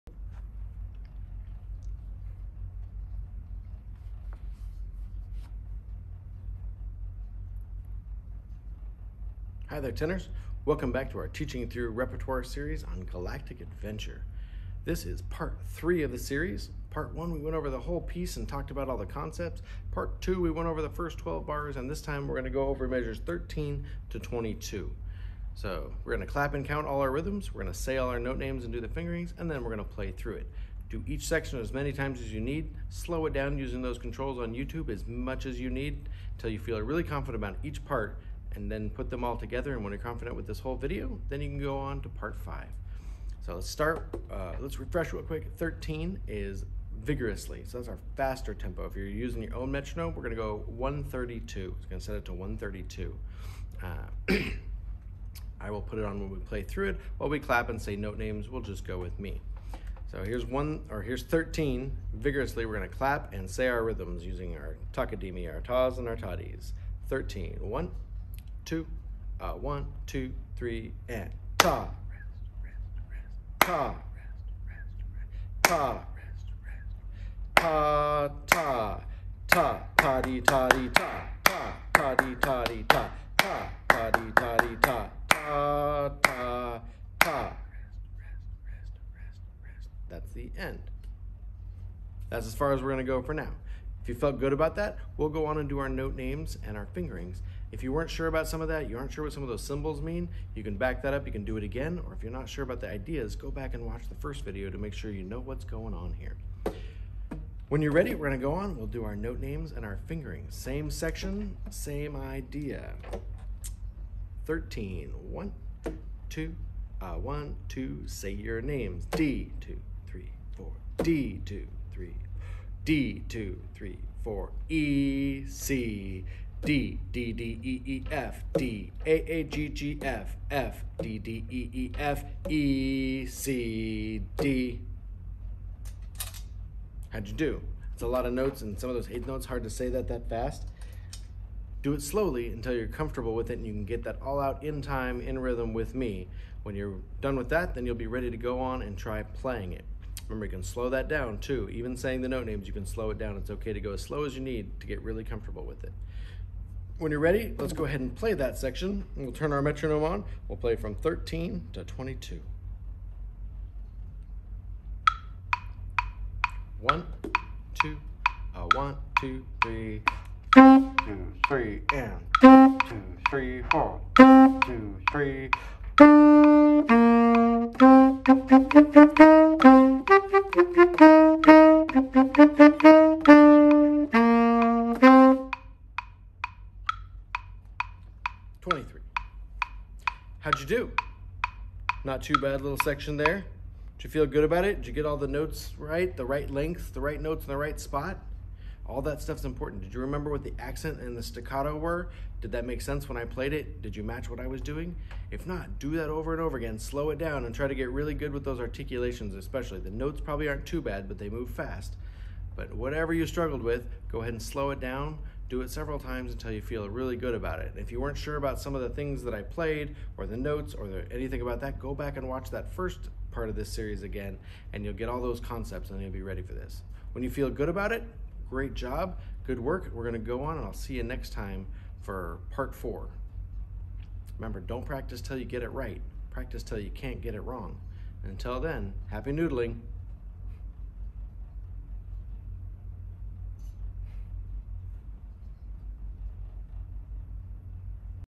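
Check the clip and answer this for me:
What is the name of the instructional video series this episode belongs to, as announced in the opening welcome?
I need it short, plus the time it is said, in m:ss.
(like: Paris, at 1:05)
Teaching Through Repertoire, at 0:11.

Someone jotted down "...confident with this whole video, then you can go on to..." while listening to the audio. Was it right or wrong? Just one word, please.
right.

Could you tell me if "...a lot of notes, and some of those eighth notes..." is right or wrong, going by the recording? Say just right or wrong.
right.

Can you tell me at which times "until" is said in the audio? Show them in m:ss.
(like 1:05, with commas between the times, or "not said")
0:36, 2:22, 3:36, 3:58.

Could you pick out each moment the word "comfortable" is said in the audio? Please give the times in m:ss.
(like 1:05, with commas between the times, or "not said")
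2:22, 2:35.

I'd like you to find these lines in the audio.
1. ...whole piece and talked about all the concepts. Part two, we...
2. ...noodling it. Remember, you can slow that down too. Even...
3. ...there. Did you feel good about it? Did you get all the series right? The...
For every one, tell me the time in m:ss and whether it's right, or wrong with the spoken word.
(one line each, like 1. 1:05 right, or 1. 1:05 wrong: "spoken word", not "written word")
1. 0:17 right
2. 2:29 wrong: "playing", not "noodling"
3. 3:13 wrong: "notes", not "series".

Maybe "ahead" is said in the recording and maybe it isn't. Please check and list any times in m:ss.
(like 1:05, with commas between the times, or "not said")
2:37, 3:34.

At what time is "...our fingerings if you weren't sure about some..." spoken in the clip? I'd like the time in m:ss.
1:36.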